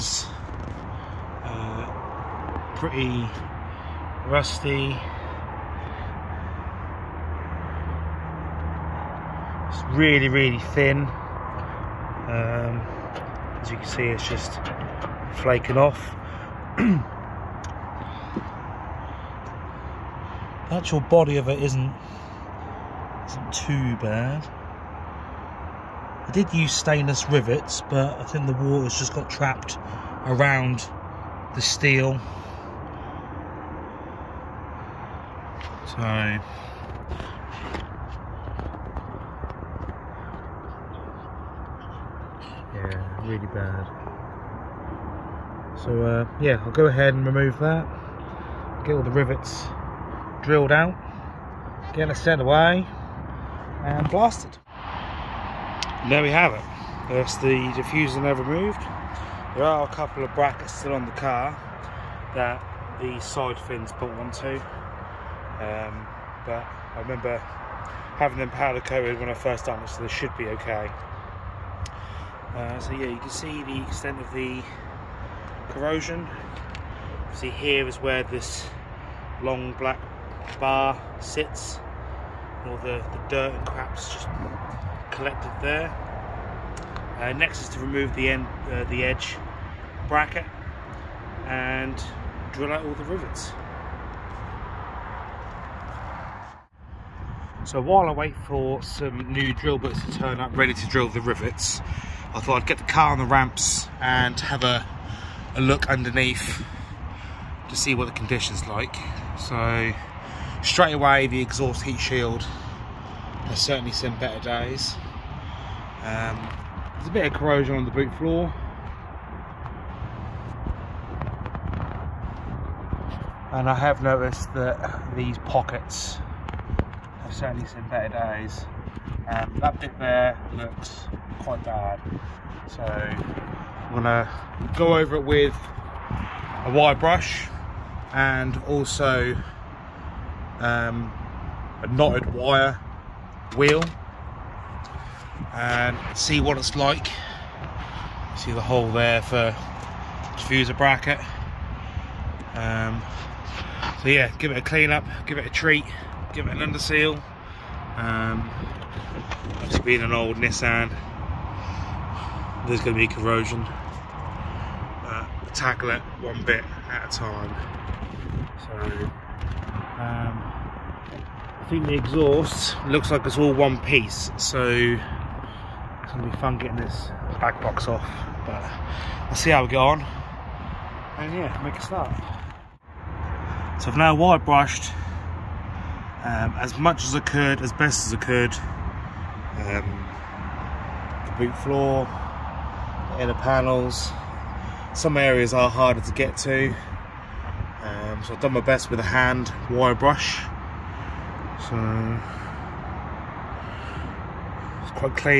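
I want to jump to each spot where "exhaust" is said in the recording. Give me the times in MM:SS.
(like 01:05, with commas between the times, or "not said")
01:51, 02:51.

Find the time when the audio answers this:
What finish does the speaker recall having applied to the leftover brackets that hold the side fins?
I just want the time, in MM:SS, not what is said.
01:08.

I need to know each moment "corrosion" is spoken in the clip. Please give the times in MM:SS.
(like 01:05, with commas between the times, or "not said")
01:15, 01:57, 02:43.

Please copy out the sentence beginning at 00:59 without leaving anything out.
There are a couple of brackets still on the car that the side fins put onto.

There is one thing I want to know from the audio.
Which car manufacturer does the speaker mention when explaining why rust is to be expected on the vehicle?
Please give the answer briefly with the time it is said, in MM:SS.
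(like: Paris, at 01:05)
Nissan, at 02:40.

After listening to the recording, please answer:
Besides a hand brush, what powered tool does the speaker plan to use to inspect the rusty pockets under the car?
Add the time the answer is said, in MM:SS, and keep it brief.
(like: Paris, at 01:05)
knotted wire wheel, at 02:21.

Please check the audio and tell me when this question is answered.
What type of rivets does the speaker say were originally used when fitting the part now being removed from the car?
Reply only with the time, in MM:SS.
00:26.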